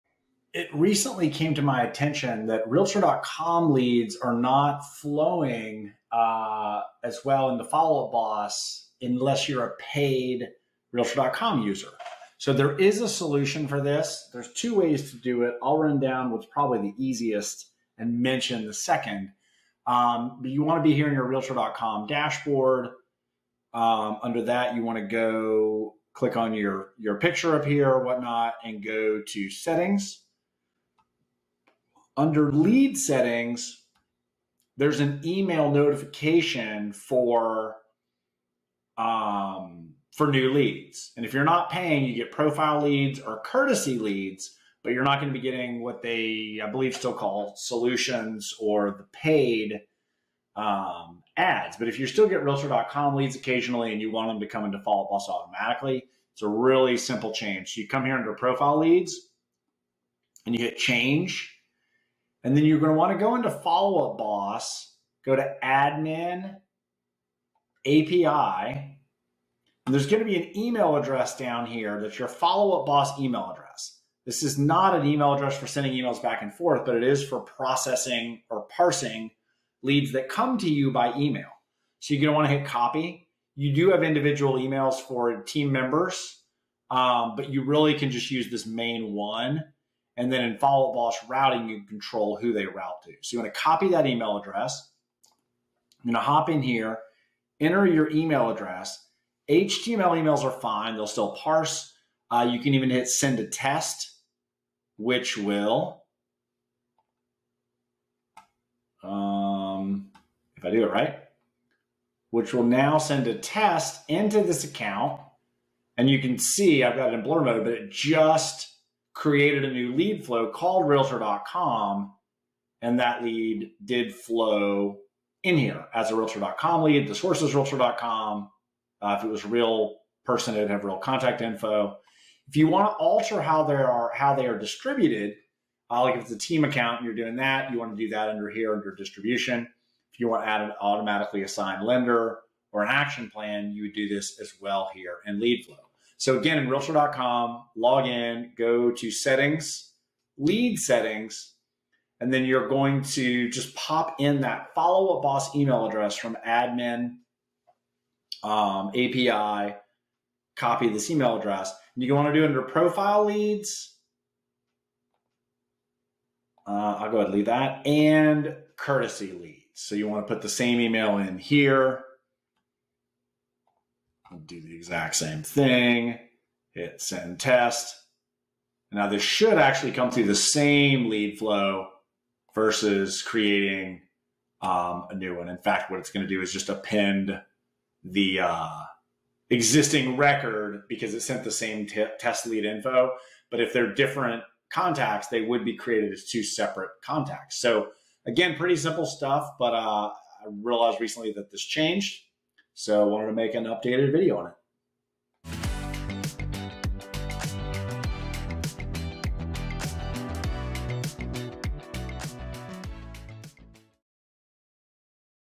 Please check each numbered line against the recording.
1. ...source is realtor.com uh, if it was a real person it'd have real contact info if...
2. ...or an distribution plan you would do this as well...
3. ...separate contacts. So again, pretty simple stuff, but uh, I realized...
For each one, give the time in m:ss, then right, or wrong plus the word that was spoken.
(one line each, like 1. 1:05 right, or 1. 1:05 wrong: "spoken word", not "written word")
1. 2:07 right
2. 2:22 wrong: "action", not "distribution"
3. 3:16 right.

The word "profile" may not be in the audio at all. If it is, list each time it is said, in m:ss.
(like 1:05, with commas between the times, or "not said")
0:42, 0:58, 2:42.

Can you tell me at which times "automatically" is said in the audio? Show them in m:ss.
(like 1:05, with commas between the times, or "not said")
0:55, 2:20.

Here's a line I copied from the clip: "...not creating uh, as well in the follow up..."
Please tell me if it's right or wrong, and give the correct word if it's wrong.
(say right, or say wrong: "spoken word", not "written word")
wrong: "flowing", not "creating".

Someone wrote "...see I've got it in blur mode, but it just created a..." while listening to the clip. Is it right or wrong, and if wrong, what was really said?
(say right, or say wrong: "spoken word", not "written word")
right.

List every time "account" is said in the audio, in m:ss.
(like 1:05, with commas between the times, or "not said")
1:54, 2:16.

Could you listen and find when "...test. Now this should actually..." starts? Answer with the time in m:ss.
2:57.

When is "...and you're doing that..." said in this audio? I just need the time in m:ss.
2:16.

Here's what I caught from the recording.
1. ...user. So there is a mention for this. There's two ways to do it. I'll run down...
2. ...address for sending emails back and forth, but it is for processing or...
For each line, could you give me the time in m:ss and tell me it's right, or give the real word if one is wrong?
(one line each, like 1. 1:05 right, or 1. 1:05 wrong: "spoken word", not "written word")
1. 0:11 wrong: "solution", not "mention"
2. 1:15 right.